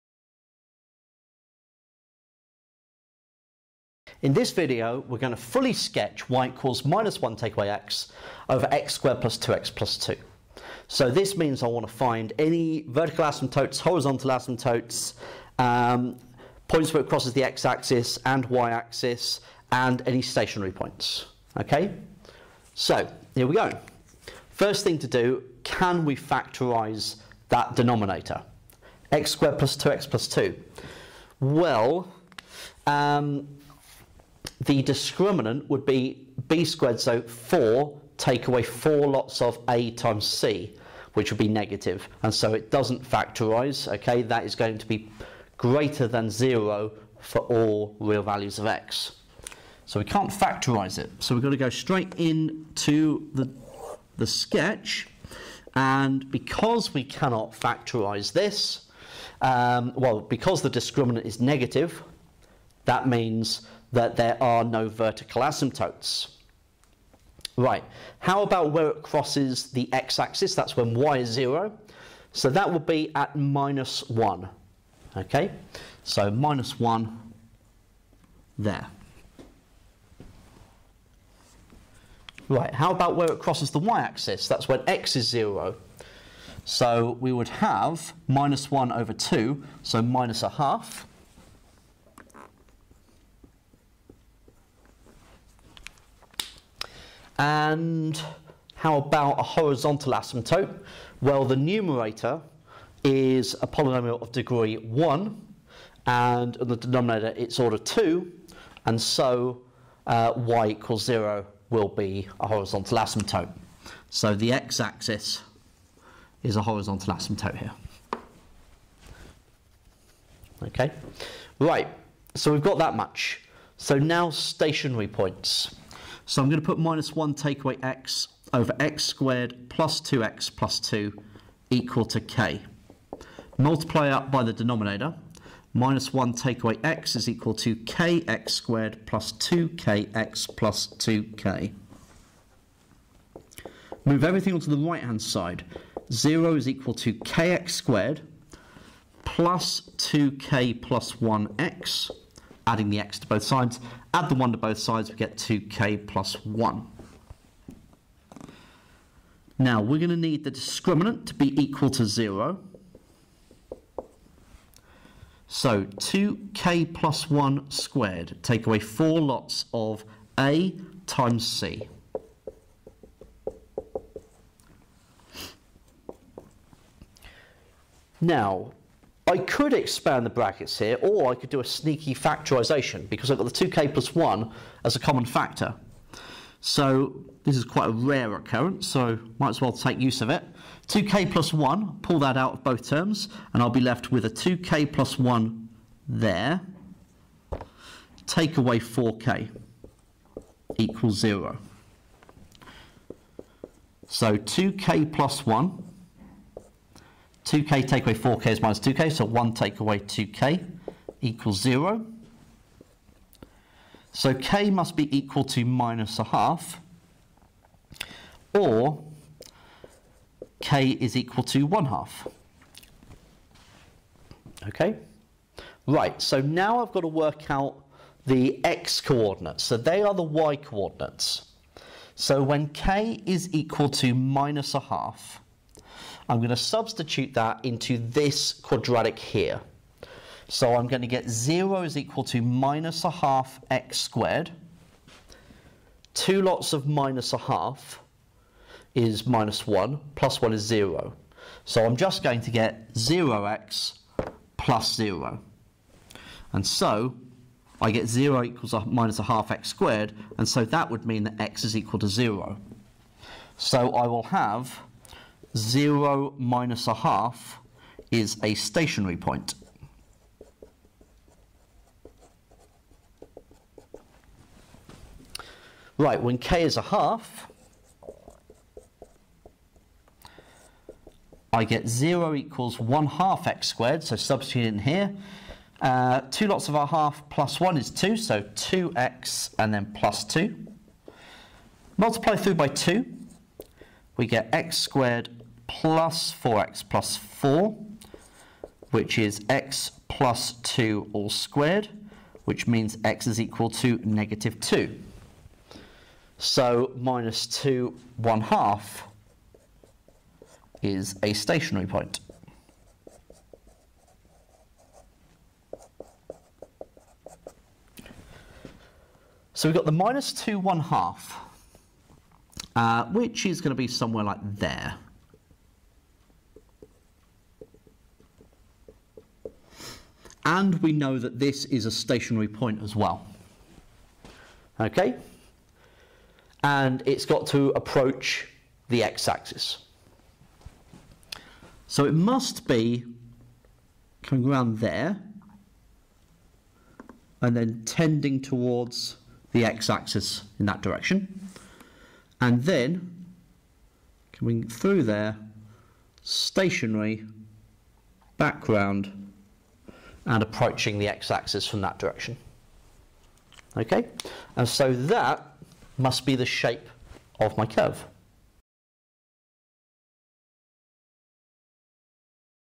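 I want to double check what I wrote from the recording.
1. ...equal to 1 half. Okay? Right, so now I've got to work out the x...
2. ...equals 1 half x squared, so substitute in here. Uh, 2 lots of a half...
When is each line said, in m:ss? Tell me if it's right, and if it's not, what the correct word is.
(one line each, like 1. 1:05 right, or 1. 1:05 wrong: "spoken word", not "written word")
1. 3:41 right
2. 4:42 right.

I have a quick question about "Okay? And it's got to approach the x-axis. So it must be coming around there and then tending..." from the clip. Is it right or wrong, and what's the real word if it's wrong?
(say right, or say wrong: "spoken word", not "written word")
right.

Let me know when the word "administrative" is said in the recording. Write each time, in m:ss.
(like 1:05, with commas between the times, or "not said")
not said.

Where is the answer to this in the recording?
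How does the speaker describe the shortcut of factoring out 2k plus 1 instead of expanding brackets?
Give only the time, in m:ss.
3:01.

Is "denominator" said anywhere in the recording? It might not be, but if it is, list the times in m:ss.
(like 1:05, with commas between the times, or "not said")
0:27, 1:46, 2:14.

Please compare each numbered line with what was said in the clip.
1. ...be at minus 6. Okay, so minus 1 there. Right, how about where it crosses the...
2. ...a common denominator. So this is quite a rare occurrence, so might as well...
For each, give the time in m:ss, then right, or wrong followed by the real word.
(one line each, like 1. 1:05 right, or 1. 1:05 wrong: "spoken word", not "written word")
1. 1:12 wrong: "1", not "6"
2. 3:04 wrong: "factor", not "denominator".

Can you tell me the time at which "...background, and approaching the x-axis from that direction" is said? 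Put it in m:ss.
5:58.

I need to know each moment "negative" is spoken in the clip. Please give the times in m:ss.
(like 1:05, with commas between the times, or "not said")
0:41, 1:01, 5:04.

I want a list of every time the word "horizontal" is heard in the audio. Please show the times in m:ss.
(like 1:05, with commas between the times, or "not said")
0:13, 1:39, 1:52, 1:56.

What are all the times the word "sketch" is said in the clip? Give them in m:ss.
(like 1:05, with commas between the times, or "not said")
0:05, 0:54.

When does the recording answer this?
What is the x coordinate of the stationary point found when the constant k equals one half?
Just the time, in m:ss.
5:04.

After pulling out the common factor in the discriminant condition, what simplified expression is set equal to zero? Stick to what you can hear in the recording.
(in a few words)
1 - 2k.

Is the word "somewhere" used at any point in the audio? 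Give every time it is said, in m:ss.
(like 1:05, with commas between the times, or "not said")
5:23.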